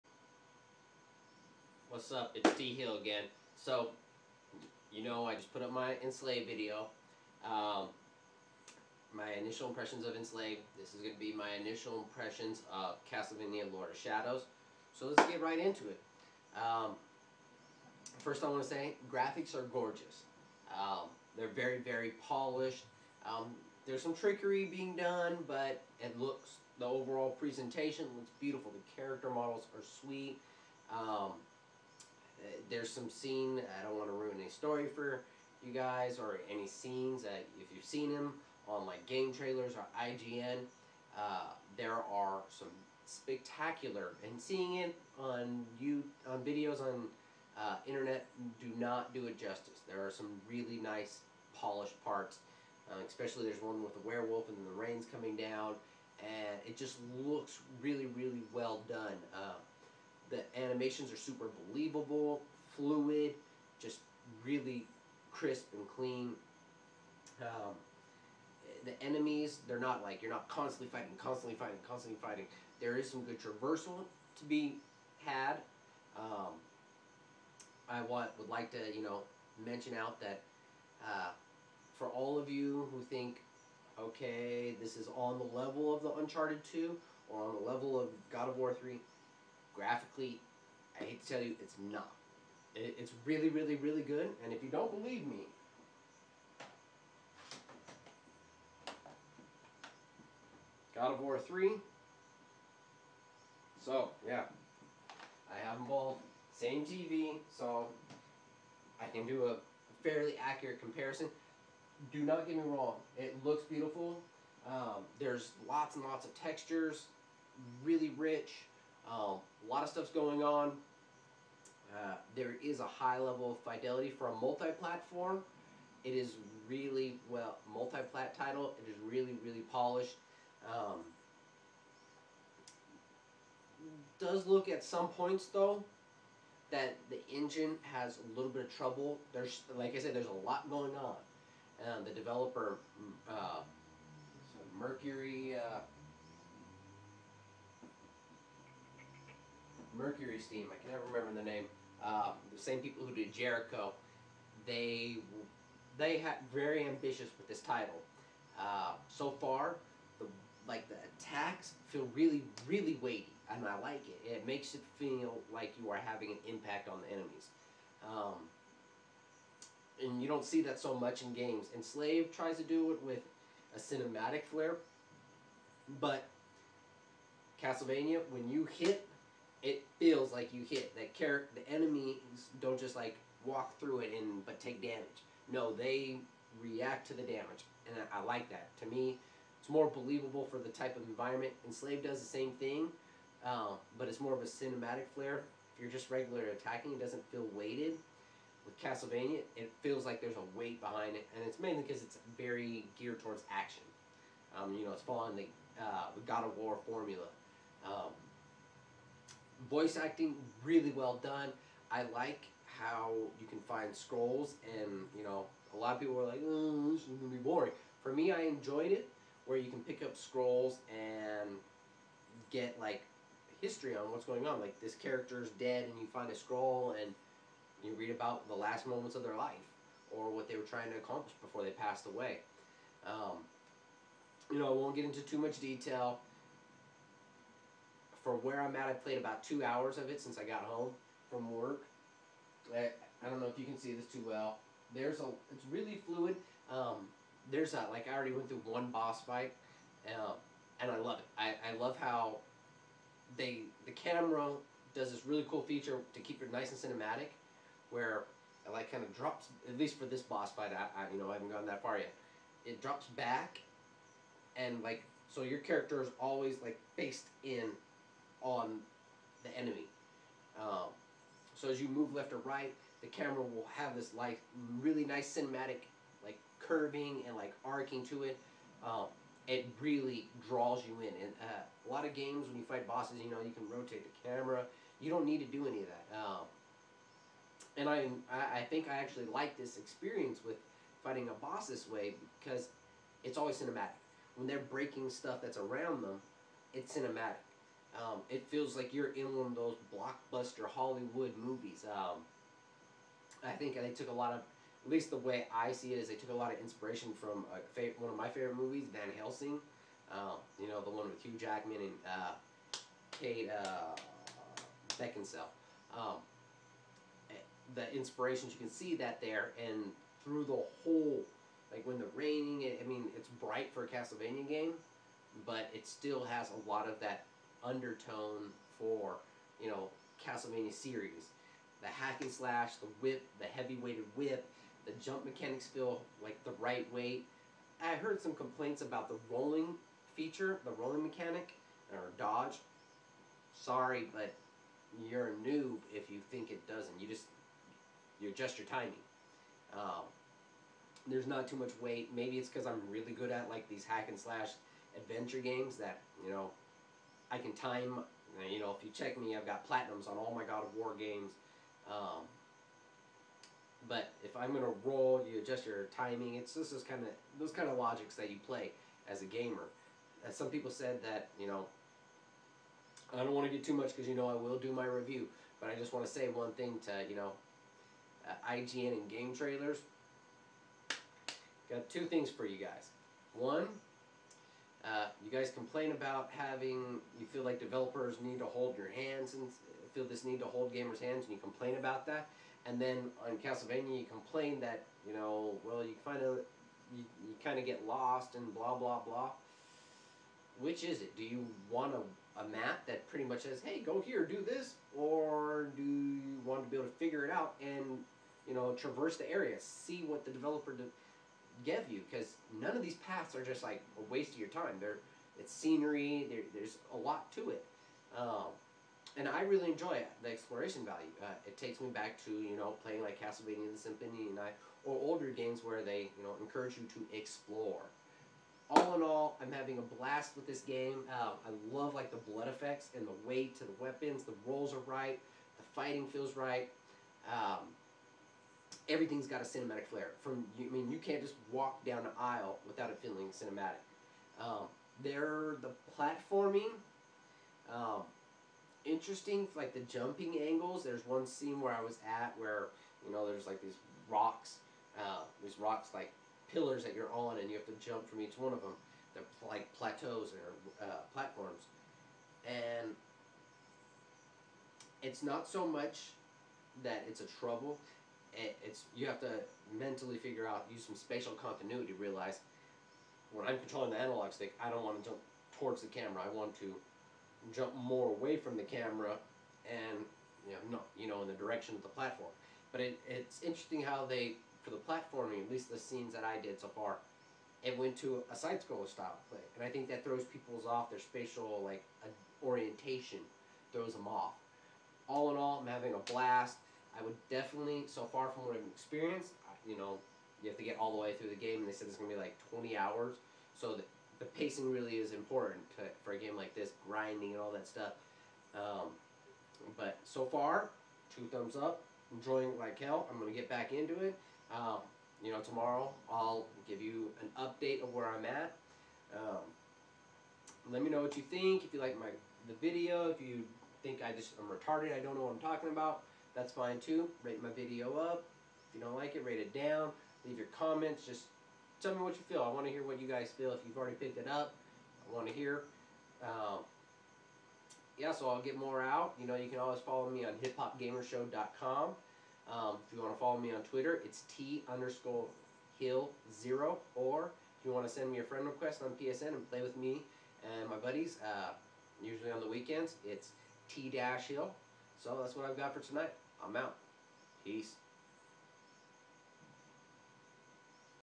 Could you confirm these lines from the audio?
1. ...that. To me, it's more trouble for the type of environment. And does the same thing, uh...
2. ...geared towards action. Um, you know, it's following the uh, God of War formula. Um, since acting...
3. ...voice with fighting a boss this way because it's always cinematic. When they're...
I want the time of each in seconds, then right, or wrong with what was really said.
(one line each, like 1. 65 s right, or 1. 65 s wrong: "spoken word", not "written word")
1. 188 s wrong: "believable", not "trouble"
2. 202 s wrong: "voice", not "since"
3. 289 s wrong: "experience", not "voice".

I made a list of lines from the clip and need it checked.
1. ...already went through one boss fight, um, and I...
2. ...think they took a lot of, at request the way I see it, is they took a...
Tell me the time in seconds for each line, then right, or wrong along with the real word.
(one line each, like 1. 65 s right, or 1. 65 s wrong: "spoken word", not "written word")
1. 248 s right
2. 303 s wrong: "least", not "request".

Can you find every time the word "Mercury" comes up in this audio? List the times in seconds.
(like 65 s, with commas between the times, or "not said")
144 s, 149 s.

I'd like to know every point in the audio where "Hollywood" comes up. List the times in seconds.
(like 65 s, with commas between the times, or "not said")
300 s.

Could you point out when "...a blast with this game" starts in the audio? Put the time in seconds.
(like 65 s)
429 s.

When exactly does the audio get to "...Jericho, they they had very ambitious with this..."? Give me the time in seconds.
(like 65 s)
153 s.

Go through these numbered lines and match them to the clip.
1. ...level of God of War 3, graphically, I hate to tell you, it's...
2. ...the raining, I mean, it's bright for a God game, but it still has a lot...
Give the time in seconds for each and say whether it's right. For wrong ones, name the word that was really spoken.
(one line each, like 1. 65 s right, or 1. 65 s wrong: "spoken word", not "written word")
1. 87 s right
2. 321 s wrong: "Castlevania", not "God".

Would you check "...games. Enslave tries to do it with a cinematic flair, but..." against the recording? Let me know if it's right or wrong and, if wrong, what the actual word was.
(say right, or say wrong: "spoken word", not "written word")
right.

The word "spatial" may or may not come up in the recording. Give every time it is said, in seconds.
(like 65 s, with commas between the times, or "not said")
470 s, 490 s.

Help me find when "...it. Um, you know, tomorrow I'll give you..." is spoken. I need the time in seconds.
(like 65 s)
514 s.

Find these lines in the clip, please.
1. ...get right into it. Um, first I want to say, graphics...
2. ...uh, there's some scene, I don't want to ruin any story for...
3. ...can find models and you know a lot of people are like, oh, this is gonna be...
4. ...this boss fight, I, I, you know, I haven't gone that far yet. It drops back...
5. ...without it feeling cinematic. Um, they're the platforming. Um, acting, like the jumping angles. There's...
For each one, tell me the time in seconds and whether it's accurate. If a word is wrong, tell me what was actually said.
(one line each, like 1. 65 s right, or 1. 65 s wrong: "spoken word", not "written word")
1. 15 s right
2. 32 s right
3. 213 s wrong: "scrolls", not "models"
4. 260 s right
5. 442 s wrong: "interesting", not "acting".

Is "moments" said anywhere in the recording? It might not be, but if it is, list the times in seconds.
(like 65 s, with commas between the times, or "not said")
228 s.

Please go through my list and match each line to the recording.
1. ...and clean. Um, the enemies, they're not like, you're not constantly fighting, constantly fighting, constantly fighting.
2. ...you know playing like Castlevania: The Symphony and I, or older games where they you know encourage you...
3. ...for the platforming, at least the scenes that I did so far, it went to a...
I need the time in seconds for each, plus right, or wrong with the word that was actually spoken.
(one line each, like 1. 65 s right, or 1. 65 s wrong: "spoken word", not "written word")
1. 65 s right
2. 422 s right
3. 484 s right.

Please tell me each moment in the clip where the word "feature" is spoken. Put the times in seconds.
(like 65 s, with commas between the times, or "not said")
255 s, 340 s.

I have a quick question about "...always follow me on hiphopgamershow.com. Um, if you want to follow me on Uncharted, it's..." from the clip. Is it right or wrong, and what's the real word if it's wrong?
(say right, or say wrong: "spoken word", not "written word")
wrong: "Twitter", not "Uncharted".